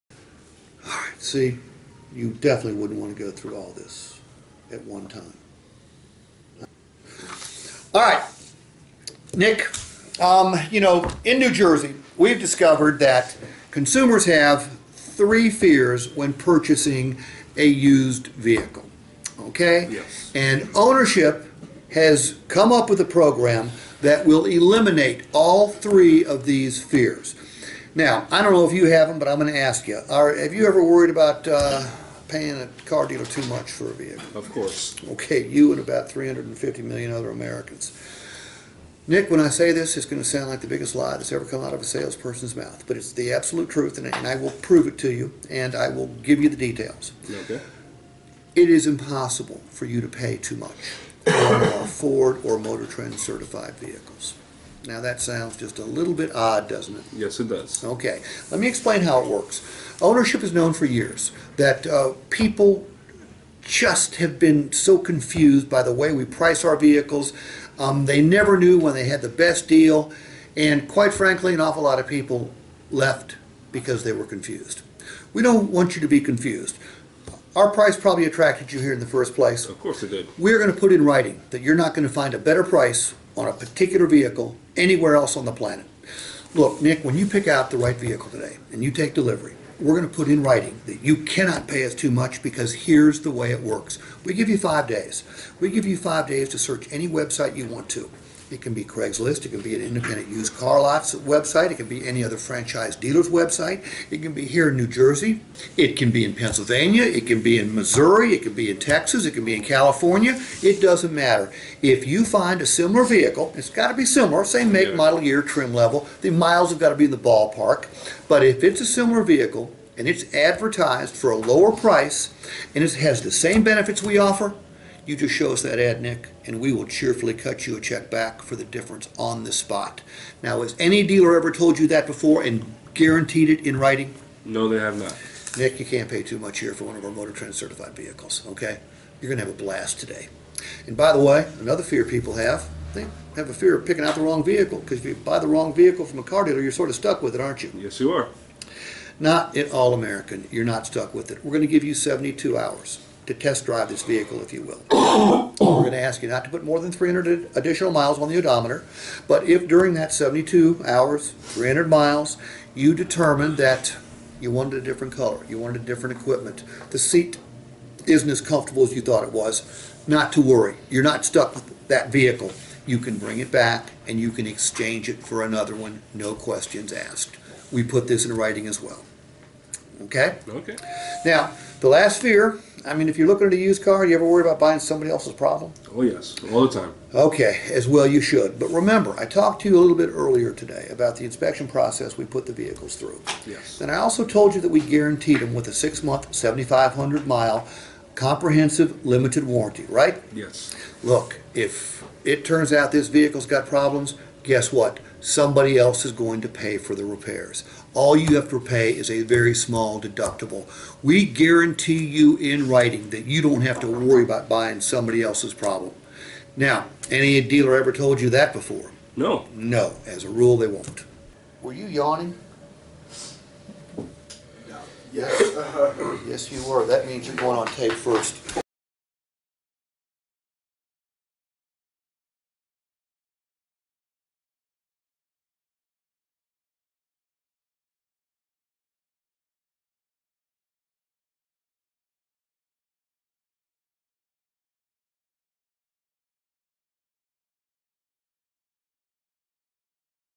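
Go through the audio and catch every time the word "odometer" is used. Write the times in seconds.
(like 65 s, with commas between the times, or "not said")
158 s.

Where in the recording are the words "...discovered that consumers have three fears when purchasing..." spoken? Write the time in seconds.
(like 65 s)
12 s.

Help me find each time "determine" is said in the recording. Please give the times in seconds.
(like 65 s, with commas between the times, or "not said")
162 s.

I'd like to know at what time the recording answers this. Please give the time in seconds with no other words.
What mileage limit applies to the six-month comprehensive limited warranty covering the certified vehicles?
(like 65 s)
196 s.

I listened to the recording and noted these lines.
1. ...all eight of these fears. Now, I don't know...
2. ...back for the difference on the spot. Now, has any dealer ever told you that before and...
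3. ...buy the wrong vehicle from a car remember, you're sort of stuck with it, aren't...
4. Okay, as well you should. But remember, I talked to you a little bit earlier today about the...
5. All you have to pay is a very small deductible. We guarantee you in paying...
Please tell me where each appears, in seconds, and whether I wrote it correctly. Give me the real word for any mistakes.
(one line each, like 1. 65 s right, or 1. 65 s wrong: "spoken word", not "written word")
1. 25 s wrong: "three", not "eight"
2. 128 s right
3. 145 s wrong: "dealer", not "remember"
4. 187 s right
5. 207 s wrong: "writing", not "paying".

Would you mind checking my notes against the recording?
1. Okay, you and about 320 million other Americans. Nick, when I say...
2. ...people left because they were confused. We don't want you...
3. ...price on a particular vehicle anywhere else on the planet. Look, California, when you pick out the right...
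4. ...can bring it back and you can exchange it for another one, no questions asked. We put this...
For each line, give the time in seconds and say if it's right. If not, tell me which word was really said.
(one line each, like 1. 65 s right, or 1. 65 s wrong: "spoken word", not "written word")
1. 35 s wrong: "350", not "320"
2. 72 s right
3. 82 s wrong: "Nick", not "California"
4. 172 s right.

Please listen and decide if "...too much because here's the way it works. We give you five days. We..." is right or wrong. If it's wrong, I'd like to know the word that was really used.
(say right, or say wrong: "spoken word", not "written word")
right.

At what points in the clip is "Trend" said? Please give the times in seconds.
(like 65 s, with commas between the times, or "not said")
52 s, 137 s.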